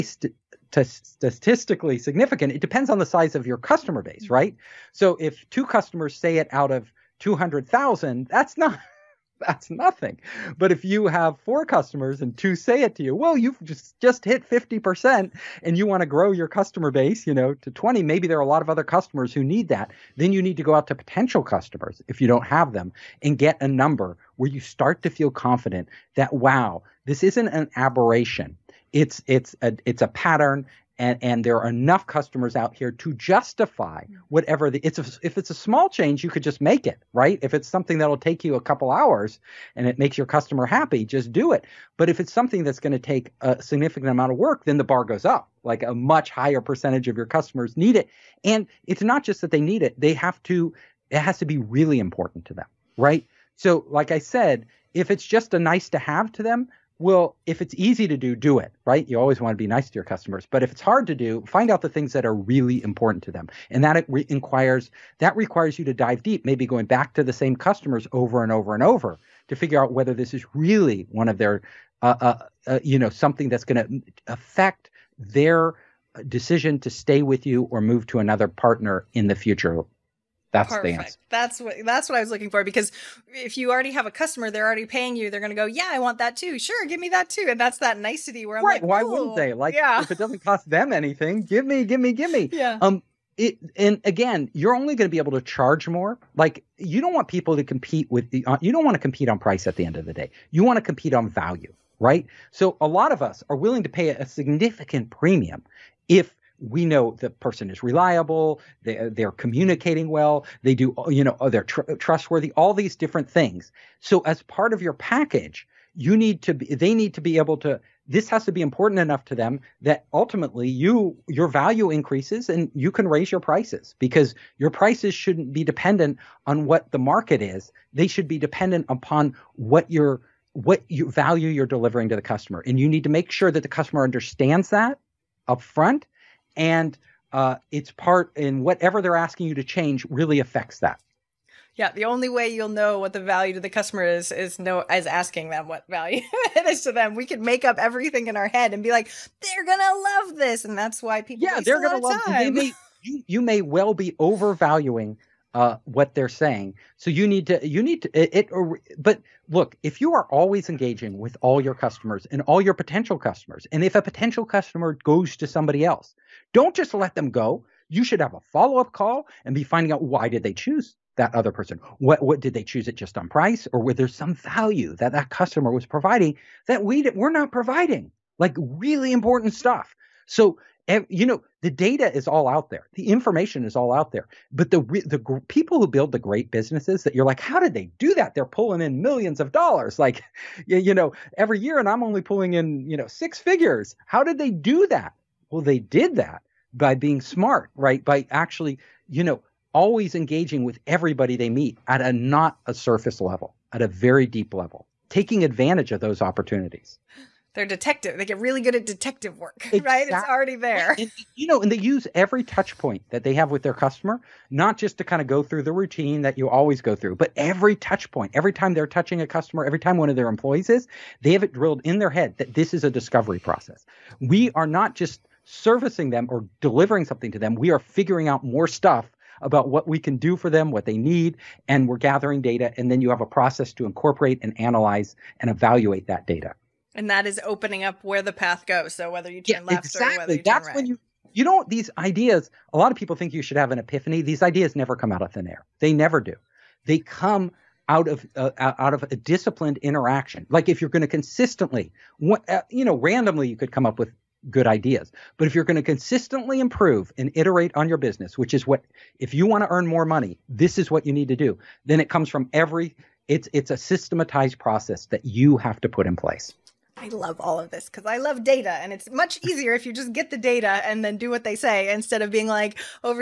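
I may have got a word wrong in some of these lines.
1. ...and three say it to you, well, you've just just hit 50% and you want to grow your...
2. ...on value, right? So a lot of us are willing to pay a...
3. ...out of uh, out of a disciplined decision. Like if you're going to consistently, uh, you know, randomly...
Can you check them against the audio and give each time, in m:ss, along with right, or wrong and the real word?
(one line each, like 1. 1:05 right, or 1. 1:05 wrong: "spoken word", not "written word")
1. 0:12 wrong: "two", not "three"
2. 1:41 right
3. 4:07 wrong: "interaction", not "decision".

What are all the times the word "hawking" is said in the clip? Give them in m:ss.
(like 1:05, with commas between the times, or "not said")
not said.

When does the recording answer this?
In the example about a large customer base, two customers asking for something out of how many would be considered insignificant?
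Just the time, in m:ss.
0:07.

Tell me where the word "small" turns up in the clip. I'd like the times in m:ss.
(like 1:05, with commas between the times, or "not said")
0:35.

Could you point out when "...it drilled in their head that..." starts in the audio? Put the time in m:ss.
3:41.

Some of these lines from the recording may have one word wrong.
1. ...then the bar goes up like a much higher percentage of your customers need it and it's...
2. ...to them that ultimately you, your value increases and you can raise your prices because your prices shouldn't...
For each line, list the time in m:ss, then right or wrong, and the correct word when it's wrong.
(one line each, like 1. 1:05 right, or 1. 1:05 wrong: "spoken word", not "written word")
1. 0:44 right
2. 1:59 right.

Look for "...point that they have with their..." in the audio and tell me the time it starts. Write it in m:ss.
3:32.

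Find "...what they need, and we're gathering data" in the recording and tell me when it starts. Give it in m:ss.
3:50.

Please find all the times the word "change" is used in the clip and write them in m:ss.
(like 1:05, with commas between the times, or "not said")
0:35, 2:19.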